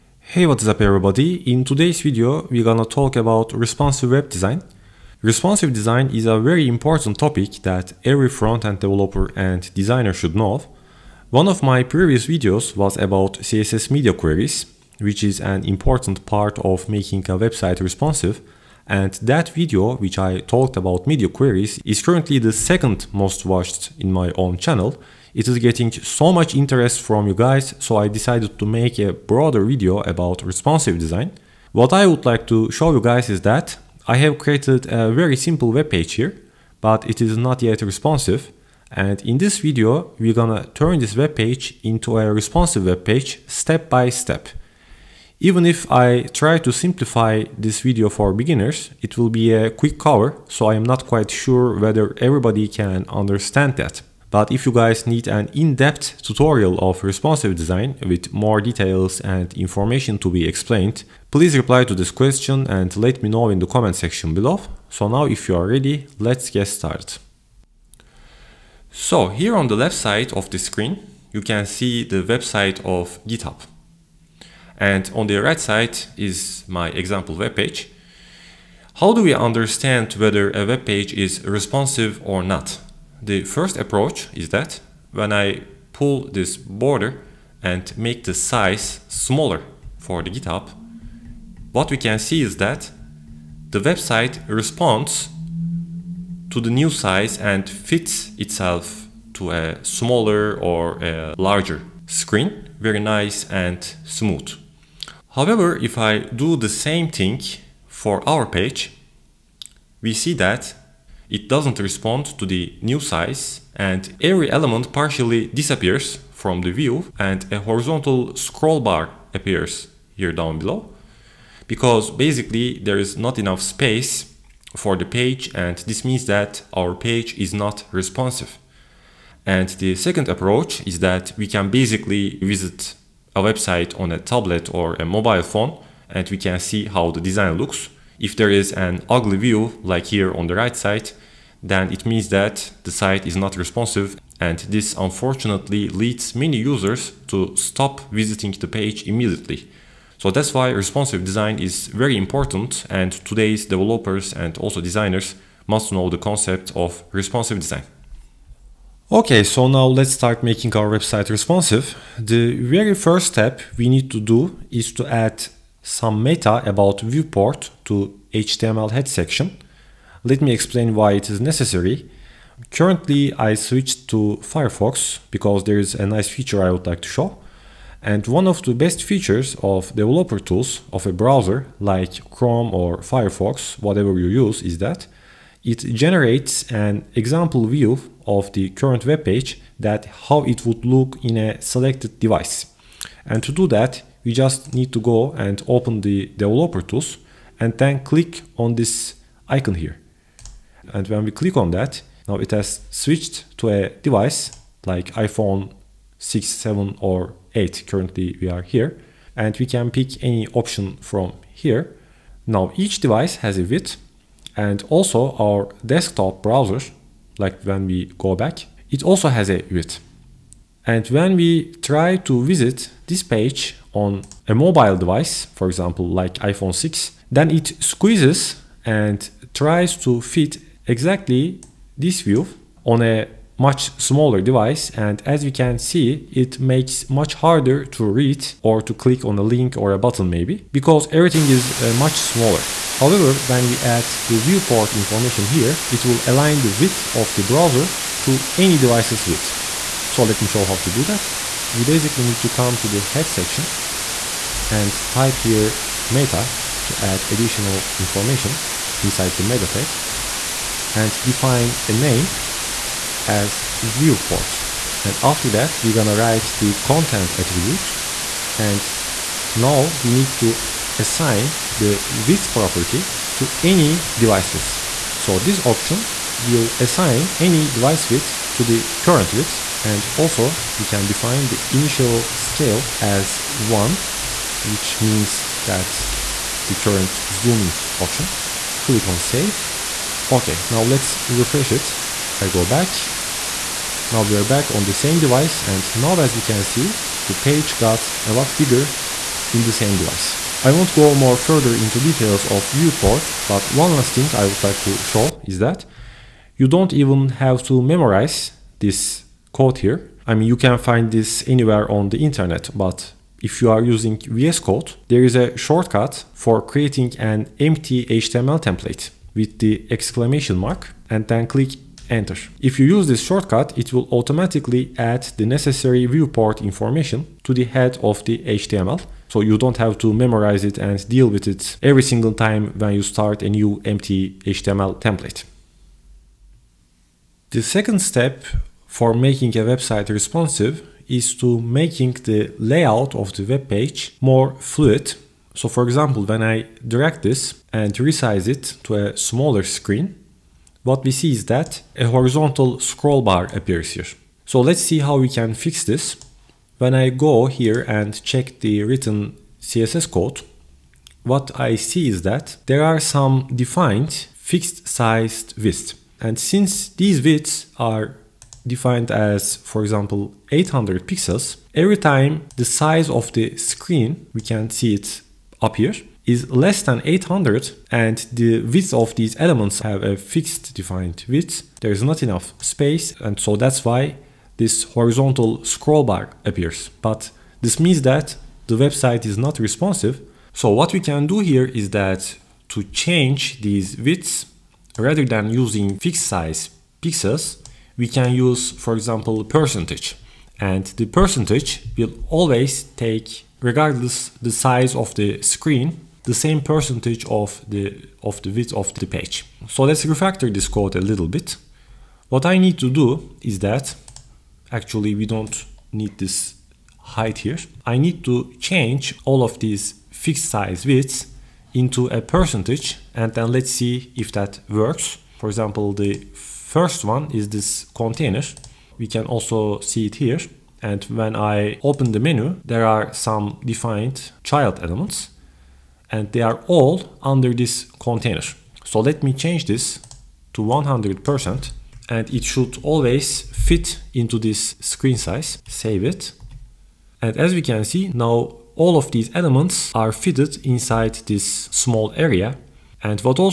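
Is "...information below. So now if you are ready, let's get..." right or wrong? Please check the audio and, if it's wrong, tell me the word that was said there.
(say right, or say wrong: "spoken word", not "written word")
wrong: "section", not "information".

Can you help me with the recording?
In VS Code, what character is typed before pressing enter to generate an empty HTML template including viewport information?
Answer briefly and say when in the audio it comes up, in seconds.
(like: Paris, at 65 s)
exclamation mark, at 319 s.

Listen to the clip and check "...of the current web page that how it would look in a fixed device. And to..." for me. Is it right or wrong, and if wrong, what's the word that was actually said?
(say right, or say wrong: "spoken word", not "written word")
wrong: "selected", not "fixed".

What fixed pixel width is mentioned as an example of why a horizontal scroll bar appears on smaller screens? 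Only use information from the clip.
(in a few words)
800 pixels.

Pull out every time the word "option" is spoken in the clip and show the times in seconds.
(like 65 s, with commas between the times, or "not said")
210 s, 275 s, 287 s.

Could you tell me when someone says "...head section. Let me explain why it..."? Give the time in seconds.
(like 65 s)
168 s.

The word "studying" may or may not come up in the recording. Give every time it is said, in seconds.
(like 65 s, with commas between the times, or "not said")
not said.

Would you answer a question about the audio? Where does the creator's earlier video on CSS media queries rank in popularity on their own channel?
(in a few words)
second most watched.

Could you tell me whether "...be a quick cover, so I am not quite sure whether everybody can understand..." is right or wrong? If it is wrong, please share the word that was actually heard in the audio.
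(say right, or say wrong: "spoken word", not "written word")
right.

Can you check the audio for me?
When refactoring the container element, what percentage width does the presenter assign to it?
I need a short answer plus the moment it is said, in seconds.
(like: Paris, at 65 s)
100%, at 440 s.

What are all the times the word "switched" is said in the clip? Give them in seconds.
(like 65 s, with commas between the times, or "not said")
173 s, 202 s.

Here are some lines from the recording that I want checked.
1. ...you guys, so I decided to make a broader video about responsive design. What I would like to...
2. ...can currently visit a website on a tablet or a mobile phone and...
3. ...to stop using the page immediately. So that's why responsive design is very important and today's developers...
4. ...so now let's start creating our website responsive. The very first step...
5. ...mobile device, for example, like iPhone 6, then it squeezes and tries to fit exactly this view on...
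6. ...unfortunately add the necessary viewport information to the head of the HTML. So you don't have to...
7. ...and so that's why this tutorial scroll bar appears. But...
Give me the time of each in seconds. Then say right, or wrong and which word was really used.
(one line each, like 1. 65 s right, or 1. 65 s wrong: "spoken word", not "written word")
1. 27 s right
2. 131 s wrong: "basically", not "currently"
3. 147 s wrong: "visiting", not "using"
4. 159 s wrong: "making", not "creating"
5. 224 s right
6. 324 s wrong: "automatically", not "unfortunately"
7. 383 s wrong: "horizontal", not "tutorial".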